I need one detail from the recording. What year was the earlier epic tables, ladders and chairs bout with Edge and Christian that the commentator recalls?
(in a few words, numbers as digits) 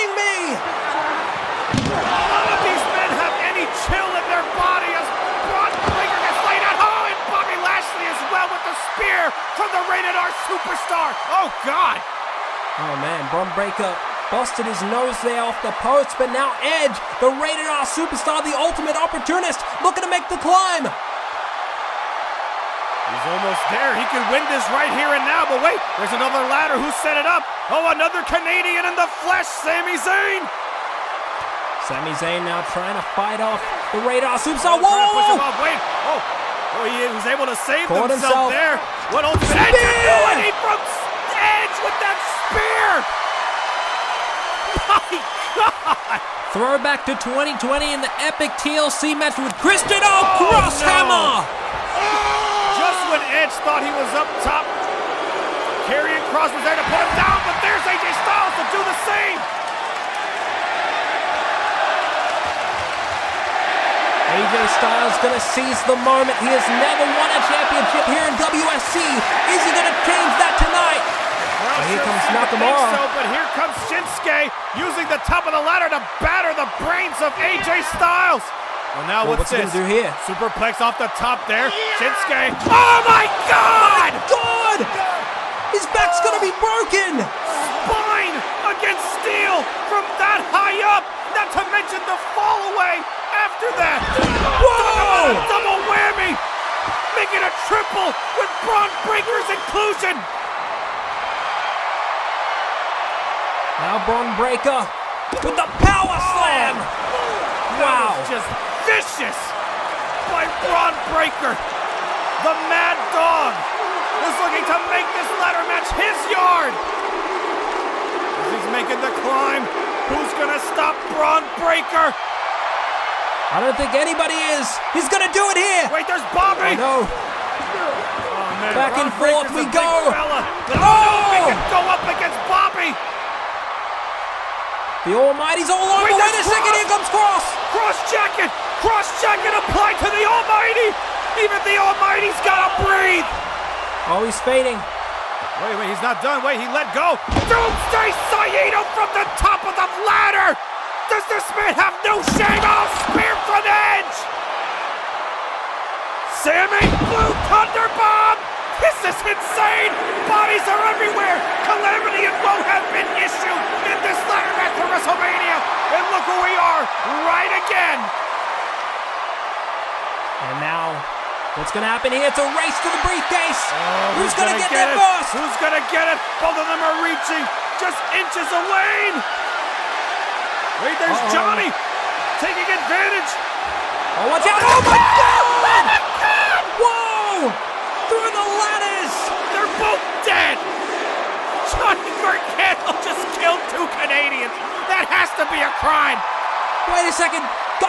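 2020.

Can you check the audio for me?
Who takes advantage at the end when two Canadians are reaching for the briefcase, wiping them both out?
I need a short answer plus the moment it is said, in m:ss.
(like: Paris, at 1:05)
Johnny Gargano, at 3:11.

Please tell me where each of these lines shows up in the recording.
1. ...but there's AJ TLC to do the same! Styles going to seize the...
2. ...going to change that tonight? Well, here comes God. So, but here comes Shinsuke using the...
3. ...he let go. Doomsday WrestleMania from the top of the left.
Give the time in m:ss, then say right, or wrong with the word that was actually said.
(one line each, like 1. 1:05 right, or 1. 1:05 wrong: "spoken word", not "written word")
1. 0:57 wrong: "Styles", not "TLC"
2. 1:09 wrong: "Nakamura", not "God"
3. 2:26 wrong: "Saito", not "WrestleMania".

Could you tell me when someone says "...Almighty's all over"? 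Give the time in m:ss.
2:15.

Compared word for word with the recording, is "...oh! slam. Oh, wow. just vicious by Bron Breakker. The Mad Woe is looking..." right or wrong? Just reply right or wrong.
wrong.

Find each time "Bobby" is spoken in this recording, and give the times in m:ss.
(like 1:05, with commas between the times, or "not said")
2:06, 2:12.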